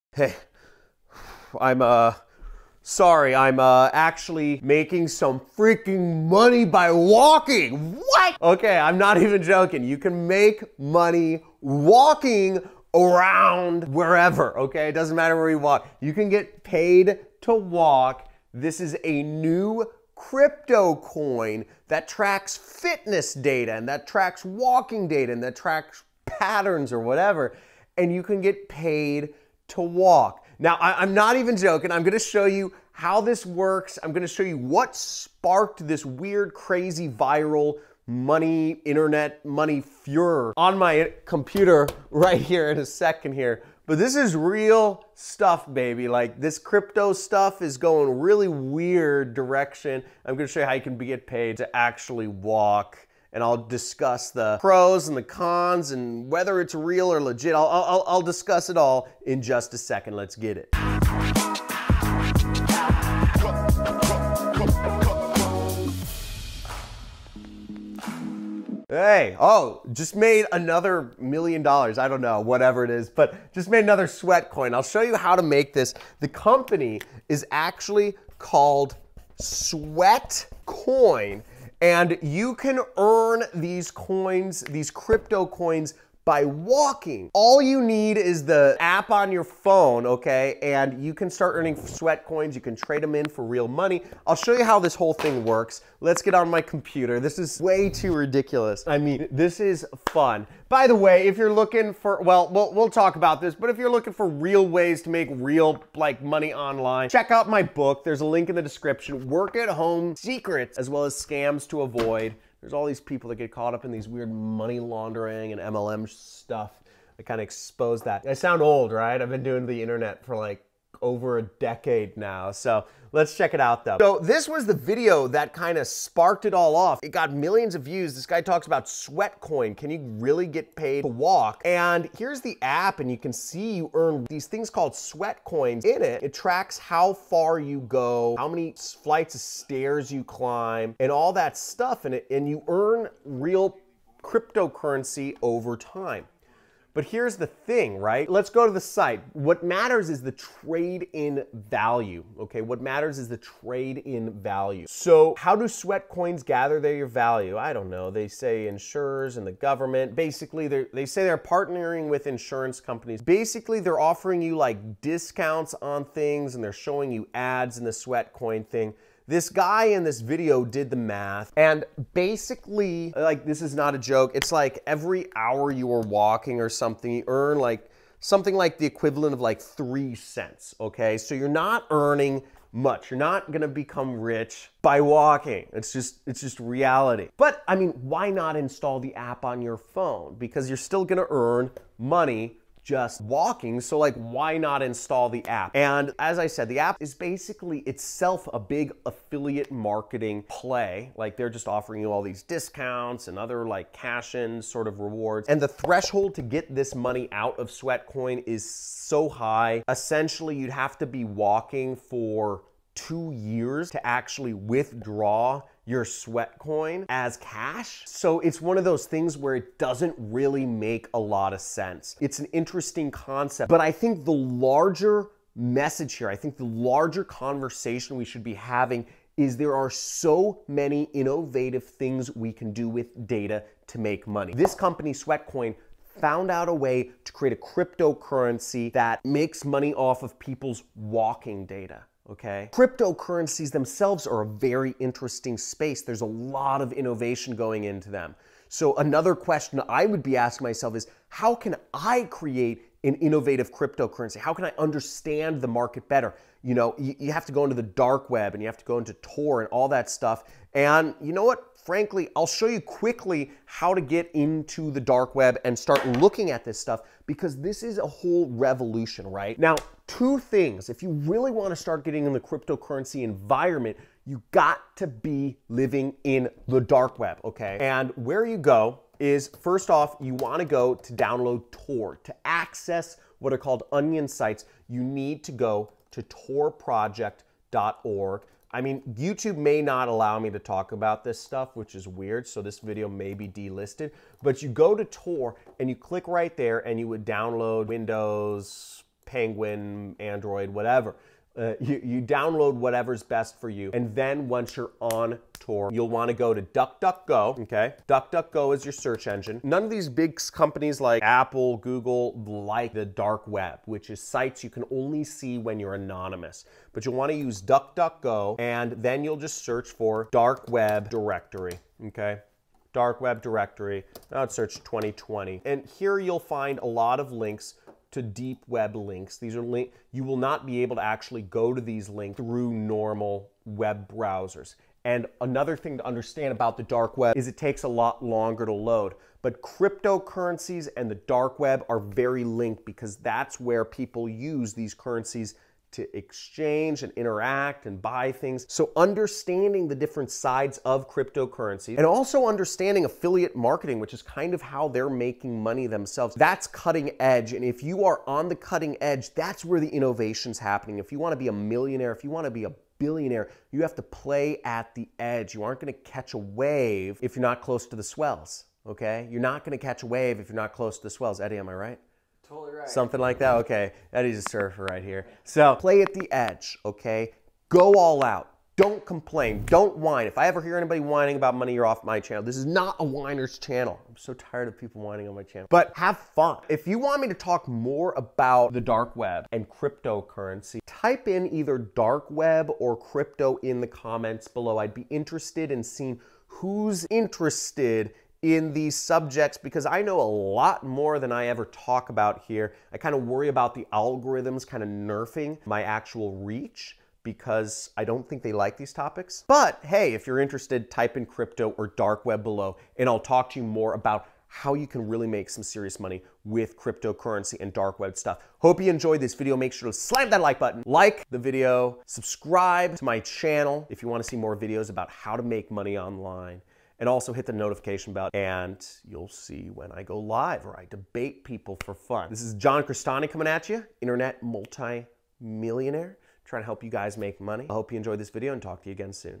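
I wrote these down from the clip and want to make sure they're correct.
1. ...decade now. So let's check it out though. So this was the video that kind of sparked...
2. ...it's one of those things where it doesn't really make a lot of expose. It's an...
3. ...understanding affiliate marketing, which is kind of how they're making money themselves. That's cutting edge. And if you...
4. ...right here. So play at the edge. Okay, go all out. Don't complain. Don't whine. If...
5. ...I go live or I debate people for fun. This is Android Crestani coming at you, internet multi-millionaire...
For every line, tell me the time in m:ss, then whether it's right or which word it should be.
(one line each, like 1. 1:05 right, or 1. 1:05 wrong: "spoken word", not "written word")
1. 2:01 right
2. 3:38 wrong: "sense", not "expose"
3. 5:52 right
4. 6:14 right
5. 7:09 wrong: "John", not "Android".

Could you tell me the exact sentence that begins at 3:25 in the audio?
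And the threshold to get this money out of Sweatcoin is so high.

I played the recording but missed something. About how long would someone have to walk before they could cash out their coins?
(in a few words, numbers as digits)
2 years.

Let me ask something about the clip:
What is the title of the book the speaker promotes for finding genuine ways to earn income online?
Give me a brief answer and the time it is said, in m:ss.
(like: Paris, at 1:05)
Work at Home Secrets, at 1:49.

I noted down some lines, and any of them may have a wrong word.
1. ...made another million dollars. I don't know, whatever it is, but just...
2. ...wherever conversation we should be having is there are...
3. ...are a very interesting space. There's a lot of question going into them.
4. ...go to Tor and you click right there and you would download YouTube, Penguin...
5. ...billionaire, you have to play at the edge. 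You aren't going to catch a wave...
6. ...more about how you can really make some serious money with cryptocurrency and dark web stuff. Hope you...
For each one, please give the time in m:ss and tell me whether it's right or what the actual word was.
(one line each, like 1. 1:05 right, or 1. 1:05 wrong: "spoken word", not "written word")
1. 1:10 right
2. 3:46 wrong: "larger", not "wherever"
3. 4:04 wrong: "innovation", not "question"
4. 4:54 wrong: "Windows", not "YouTube"
5. 6:03 right
6. 6:53 right.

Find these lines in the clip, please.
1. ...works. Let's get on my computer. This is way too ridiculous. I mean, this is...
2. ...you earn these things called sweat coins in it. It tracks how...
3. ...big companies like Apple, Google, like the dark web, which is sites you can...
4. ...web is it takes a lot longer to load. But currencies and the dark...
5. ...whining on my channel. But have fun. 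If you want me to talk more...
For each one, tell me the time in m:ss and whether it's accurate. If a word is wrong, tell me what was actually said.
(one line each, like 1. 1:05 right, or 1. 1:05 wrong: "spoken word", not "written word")
1. 1:35 right
2. 2:13 right
3. 5:10 right
4. 5:37 wrong: "cryptocurrencies", not "currencies"
5. 6:25 right.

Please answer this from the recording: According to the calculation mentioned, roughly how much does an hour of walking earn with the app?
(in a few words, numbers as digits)
3 cents.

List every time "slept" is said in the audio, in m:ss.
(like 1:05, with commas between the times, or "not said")
not said.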